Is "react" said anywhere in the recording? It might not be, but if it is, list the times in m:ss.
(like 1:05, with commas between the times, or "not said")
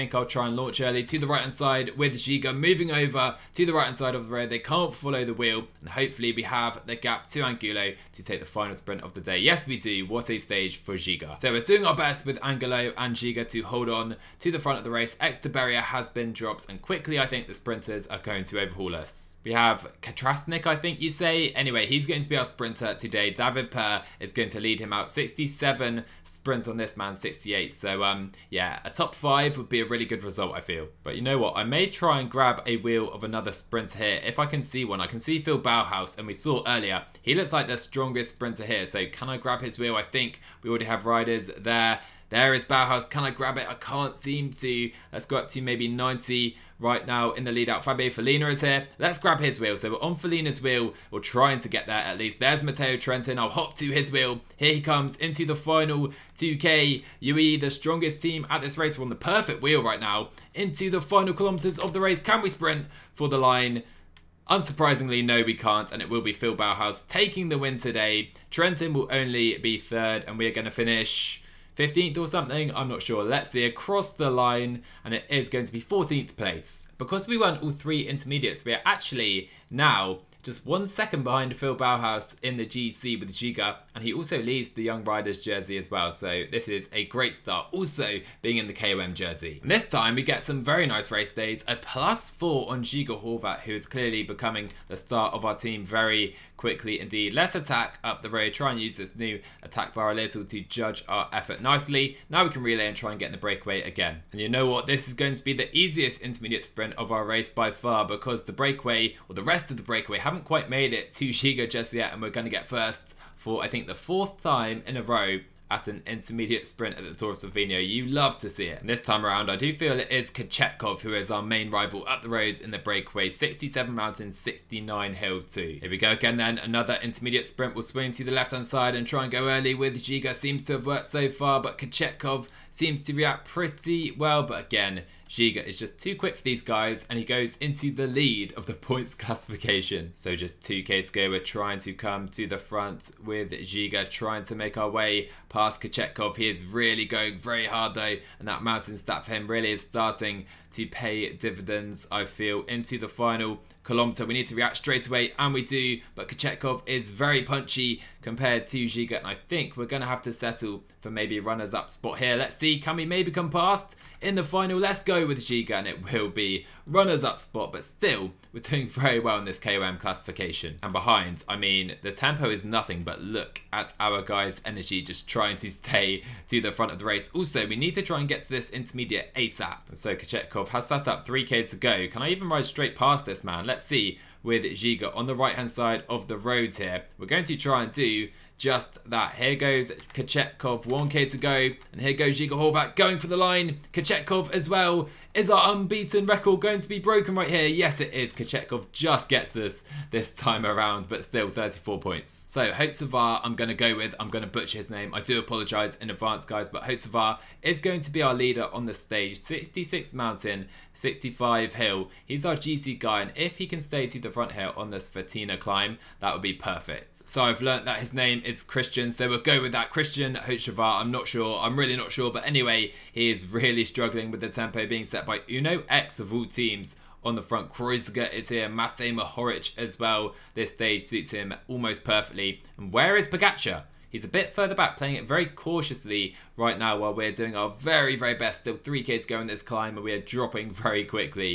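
2:13, 2:34.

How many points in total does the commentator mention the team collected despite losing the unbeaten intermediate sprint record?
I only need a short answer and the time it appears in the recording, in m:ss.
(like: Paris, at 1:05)
34, at 3:21.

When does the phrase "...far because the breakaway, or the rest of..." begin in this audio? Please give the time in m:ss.
1:47.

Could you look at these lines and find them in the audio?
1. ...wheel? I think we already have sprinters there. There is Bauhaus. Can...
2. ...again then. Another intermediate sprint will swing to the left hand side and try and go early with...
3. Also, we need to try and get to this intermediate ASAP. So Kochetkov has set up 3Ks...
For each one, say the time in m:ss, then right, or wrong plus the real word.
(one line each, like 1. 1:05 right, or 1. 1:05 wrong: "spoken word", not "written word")
1. 0:39 wrong: "riders", not "sprinters"
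2. 2:06 right
3. 2:57 right.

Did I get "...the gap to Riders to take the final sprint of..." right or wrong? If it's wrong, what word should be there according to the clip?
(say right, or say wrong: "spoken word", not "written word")
wrong: "Angulo", not "Riders".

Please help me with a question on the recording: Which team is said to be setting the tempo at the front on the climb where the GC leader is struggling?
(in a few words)
Uno X.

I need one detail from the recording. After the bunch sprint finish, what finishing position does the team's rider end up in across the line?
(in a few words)
14th.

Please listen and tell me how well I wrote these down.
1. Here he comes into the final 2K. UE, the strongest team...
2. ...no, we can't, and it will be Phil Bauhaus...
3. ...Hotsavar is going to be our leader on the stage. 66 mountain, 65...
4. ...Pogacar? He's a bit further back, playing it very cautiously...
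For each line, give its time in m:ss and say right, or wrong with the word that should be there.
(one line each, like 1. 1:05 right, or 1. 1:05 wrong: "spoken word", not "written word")
1. 0:54 right
2. 1:05 right
3. 3:26 right
4. 3:53 right.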